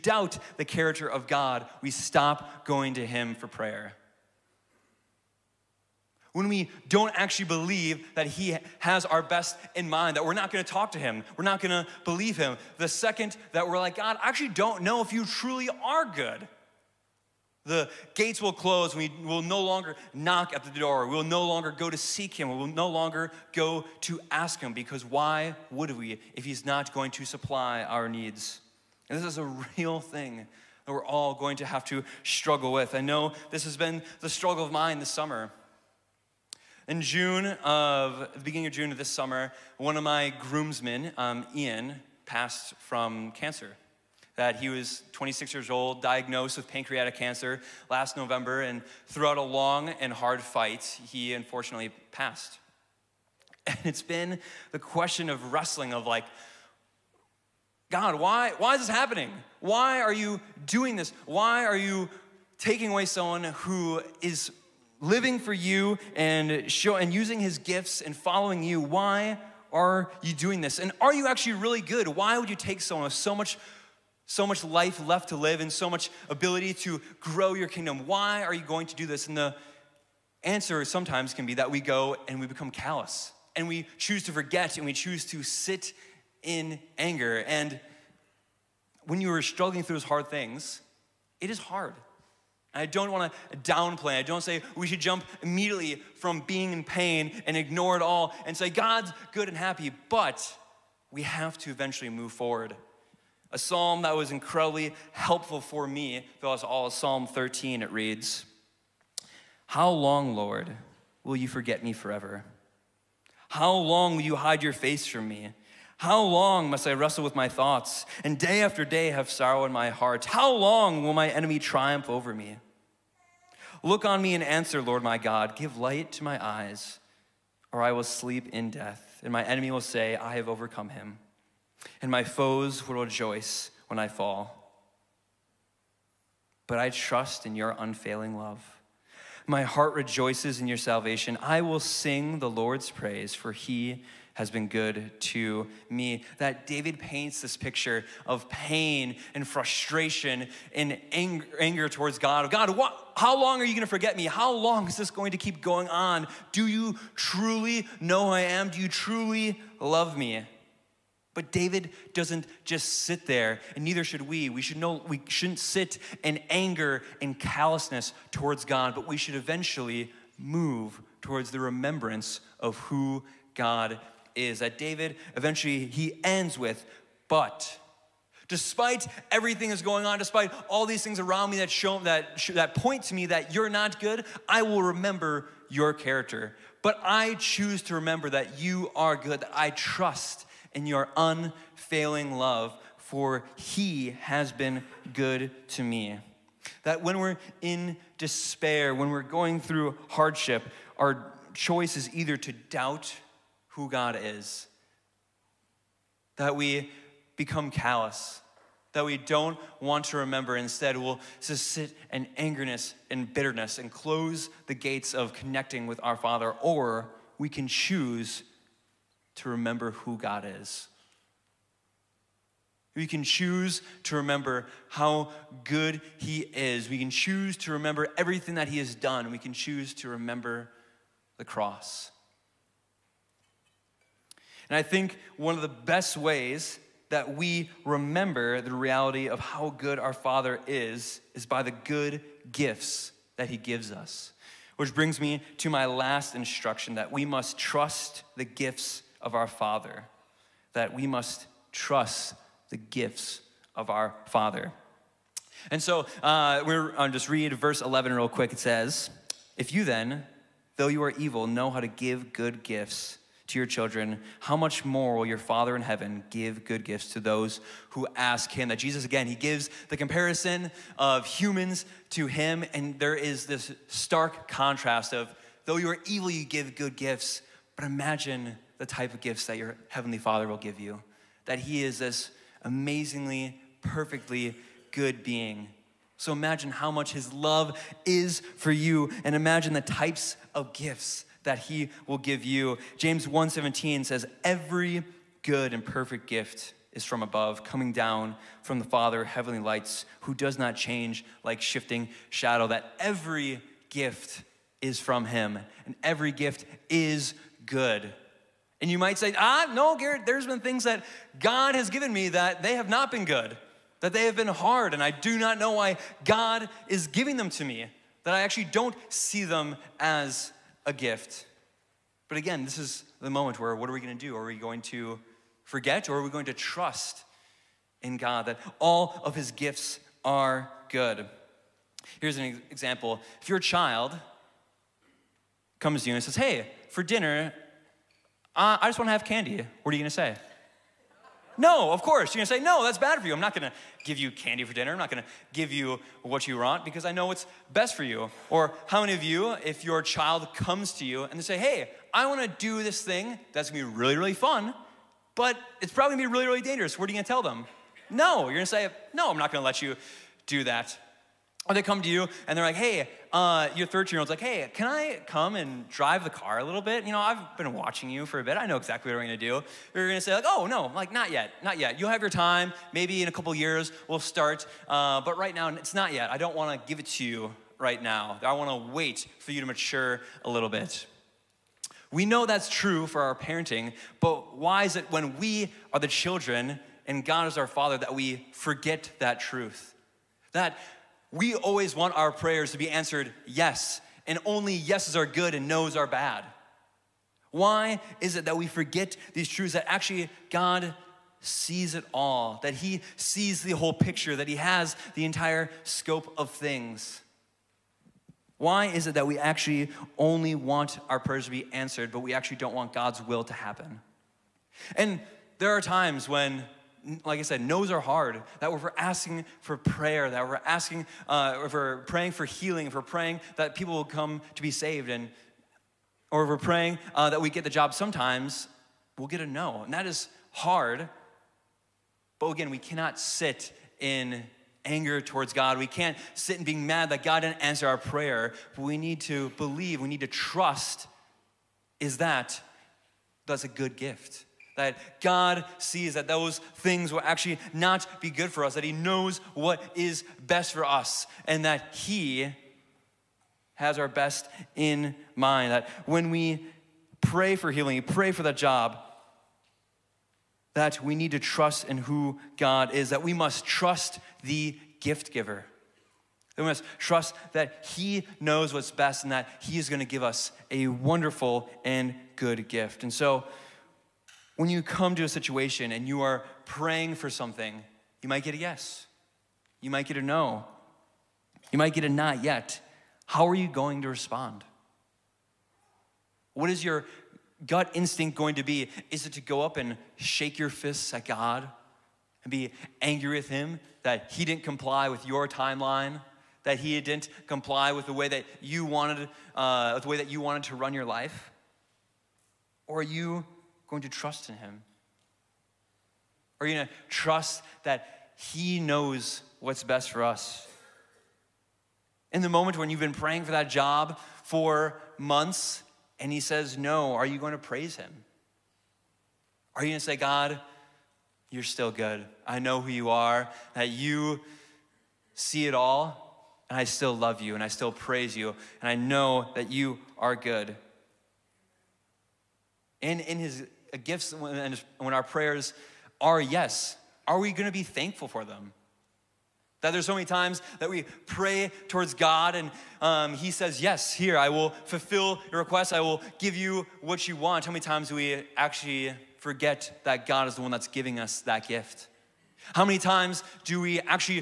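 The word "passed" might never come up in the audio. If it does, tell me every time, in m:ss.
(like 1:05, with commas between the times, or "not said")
0:42, 0:52.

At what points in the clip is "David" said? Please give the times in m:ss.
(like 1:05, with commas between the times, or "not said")
2:26, 2:41, 2:54.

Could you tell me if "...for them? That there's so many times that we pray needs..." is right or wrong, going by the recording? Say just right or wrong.
wrong.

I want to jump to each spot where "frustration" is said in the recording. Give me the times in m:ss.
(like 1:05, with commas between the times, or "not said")
2:29.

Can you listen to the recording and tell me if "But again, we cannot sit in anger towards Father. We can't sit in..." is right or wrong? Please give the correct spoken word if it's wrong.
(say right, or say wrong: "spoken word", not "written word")
wrong: "God", not "Father".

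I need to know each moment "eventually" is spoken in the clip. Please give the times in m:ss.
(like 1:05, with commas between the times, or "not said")
1:41, 2:49, 2:55.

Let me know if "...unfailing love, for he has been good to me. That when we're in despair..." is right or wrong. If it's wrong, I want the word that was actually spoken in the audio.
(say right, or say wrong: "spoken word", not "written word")
right.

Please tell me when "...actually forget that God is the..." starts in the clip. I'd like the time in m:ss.
9:08.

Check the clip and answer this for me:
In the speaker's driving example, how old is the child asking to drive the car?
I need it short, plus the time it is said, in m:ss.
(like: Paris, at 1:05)
13, at 6:03.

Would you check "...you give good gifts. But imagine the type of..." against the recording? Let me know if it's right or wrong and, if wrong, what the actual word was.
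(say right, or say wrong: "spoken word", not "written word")
right.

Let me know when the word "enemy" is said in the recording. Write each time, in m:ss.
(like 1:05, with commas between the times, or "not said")
2:01, 2:09.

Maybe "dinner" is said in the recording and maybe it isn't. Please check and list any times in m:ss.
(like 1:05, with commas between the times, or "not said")
5:37, 5:44.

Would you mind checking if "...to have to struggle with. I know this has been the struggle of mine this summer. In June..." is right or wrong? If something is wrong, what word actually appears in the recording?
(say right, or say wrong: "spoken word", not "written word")
right.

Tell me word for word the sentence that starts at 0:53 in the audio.
And it's been the question of wrestling of like, God, why, why is this happening?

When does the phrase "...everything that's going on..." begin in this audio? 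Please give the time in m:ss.
2:59.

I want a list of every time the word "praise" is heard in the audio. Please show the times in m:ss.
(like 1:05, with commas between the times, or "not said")
2:22, 8:37, 8:47.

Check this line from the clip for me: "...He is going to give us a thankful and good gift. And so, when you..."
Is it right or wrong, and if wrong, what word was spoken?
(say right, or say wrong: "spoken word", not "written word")
wrong: "wonderful", not "thankful".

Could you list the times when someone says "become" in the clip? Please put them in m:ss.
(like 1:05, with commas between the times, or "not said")
1:22, 3:27.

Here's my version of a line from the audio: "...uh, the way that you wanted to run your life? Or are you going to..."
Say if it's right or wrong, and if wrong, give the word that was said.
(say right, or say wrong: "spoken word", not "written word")
right.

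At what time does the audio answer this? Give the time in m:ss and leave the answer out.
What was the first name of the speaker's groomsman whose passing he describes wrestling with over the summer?
0:41.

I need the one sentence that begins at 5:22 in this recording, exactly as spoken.
But again, this is the moment where what are we going to do?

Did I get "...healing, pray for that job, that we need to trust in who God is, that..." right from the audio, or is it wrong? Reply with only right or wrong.
right.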